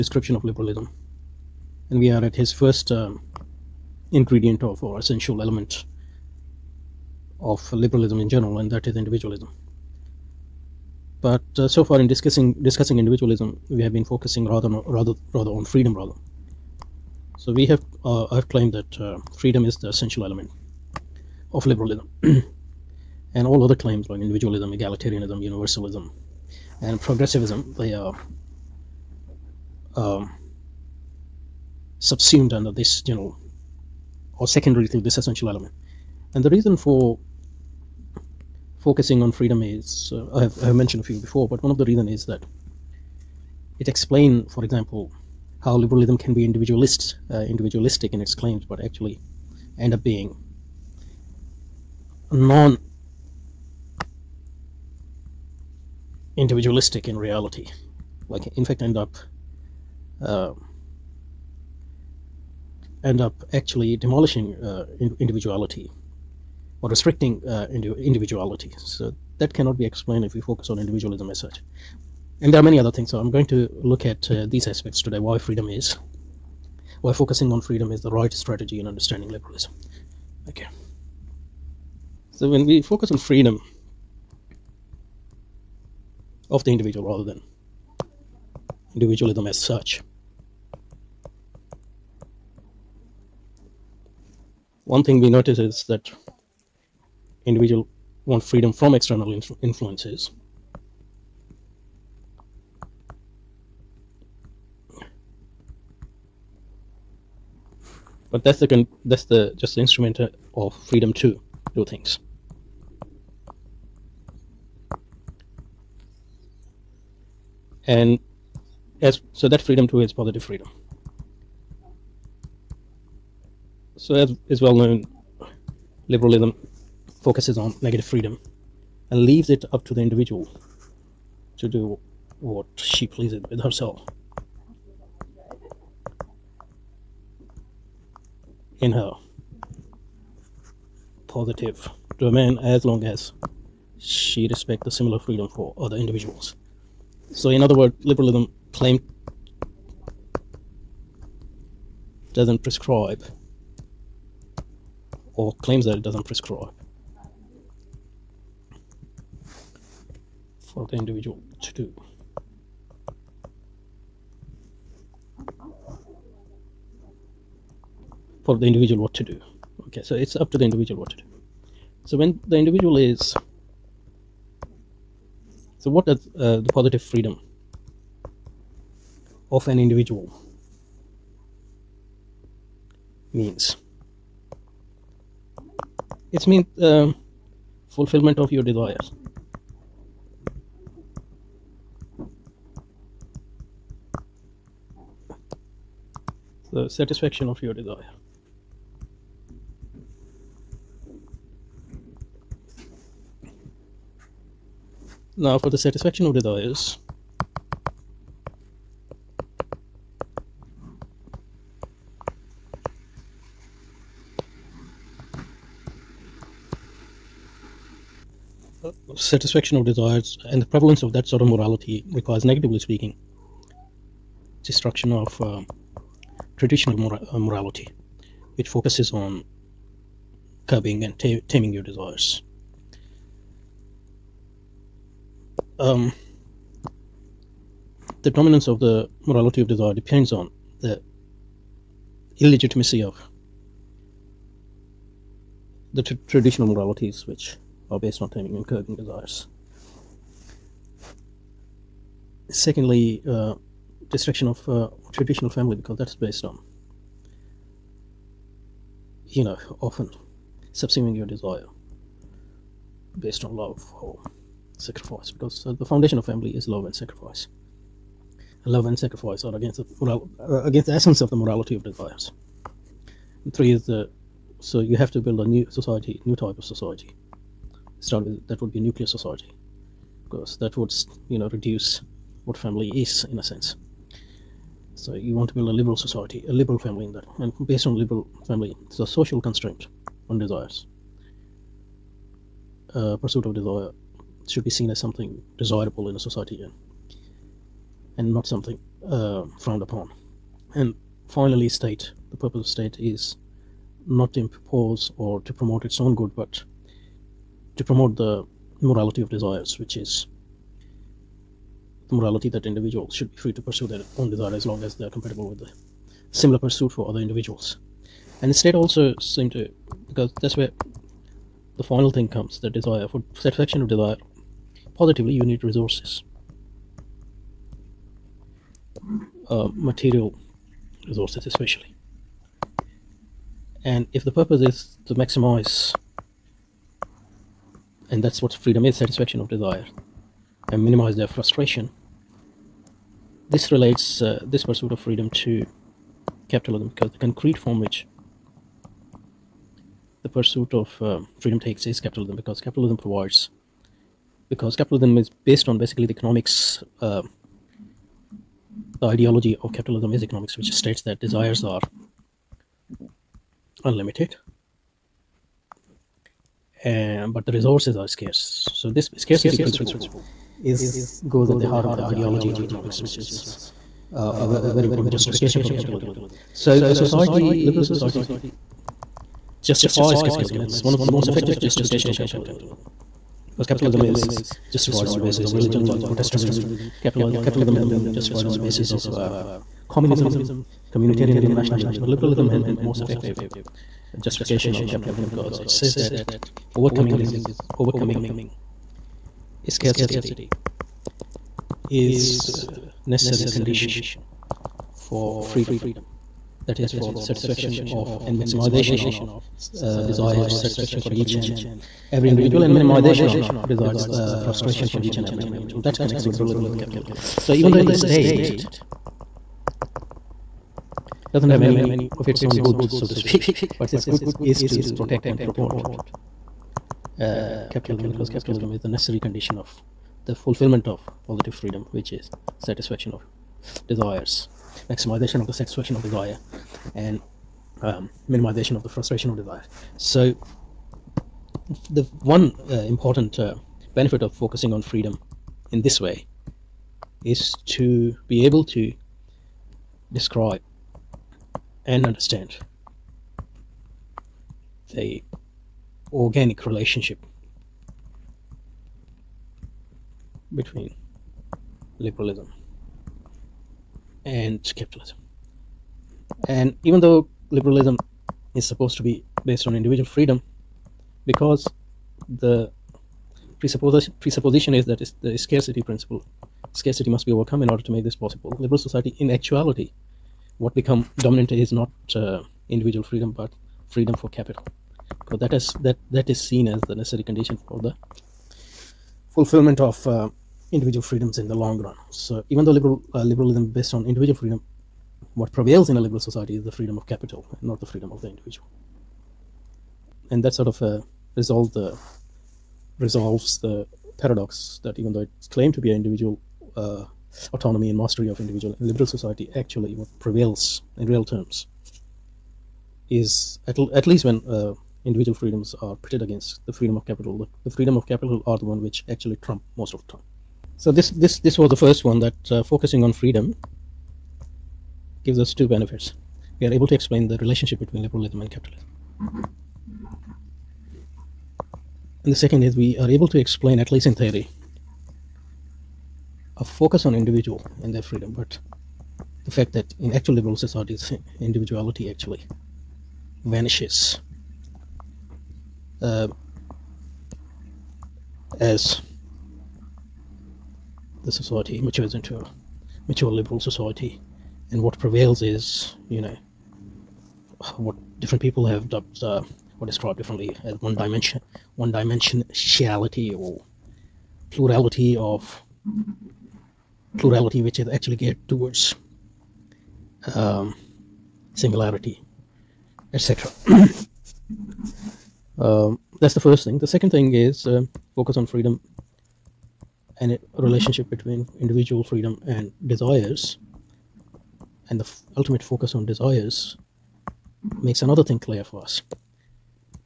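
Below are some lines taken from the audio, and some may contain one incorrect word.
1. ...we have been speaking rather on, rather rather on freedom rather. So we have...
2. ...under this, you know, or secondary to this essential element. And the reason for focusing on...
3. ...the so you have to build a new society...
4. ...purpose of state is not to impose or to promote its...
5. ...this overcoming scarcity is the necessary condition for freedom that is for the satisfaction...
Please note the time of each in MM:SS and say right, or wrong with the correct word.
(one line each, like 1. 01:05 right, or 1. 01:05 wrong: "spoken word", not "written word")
1. 00:13 wrong: "focusing", not "speaking"
2. 00:32 right
3. 04:33 right
4. 05:02 right
5. 06:37 right.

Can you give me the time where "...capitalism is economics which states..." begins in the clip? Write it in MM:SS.
05:59.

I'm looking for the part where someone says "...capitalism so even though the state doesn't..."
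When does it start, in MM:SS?
06:56.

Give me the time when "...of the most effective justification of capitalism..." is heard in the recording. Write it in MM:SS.
06:20.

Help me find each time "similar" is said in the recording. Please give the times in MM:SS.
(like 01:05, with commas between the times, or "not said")
02:24, 05:16.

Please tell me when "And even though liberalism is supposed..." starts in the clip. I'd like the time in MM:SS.
07:46.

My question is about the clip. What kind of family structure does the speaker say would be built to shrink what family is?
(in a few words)
Nuclear.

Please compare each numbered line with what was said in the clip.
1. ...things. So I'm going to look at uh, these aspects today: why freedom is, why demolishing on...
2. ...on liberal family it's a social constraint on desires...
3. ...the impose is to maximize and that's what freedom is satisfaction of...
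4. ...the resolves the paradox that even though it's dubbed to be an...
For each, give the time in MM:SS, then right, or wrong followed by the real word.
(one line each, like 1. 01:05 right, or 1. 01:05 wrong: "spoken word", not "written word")
1. 01:12 wrong: "focusing", not "demolishing"
2. 04:47 right
3. 05:34 wrong: "purpose", not "impose"
4. 08:21 wrong: "claimed", not "dubbed".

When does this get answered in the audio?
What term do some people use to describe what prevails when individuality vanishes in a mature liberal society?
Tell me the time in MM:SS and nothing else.
09:21.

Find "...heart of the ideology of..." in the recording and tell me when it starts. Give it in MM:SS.
06:11.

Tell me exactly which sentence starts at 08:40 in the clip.
So this this this was the first one that uh, focusing on freedom gives us two benefits.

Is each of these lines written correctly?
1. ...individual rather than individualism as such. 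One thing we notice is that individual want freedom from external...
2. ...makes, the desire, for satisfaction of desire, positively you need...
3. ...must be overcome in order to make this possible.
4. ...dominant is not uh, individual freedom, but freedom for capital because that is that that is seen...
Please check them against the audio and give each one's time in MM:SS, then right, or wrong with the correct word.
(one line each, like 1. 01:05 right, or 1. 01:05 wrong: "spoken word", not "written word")
1. 01:26 right
2. 05:22 wrong: "comes", not "makes"
3. 07:57 right
4. 08:01 right.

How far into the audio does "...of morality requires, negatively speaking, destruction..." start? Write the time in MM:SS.
03:41.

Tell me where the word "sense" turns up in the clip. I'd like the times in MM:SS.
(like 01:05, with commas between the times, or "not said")
04:43.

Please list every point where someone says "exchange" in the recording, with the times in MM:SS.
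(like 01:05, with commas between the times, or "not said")
not said.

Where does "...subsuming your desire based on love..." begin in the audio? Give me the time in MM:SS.
04:20.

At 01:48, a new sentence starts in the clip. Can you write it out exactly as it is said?
But that's the that's the just the instrument uh, of freedom to do things.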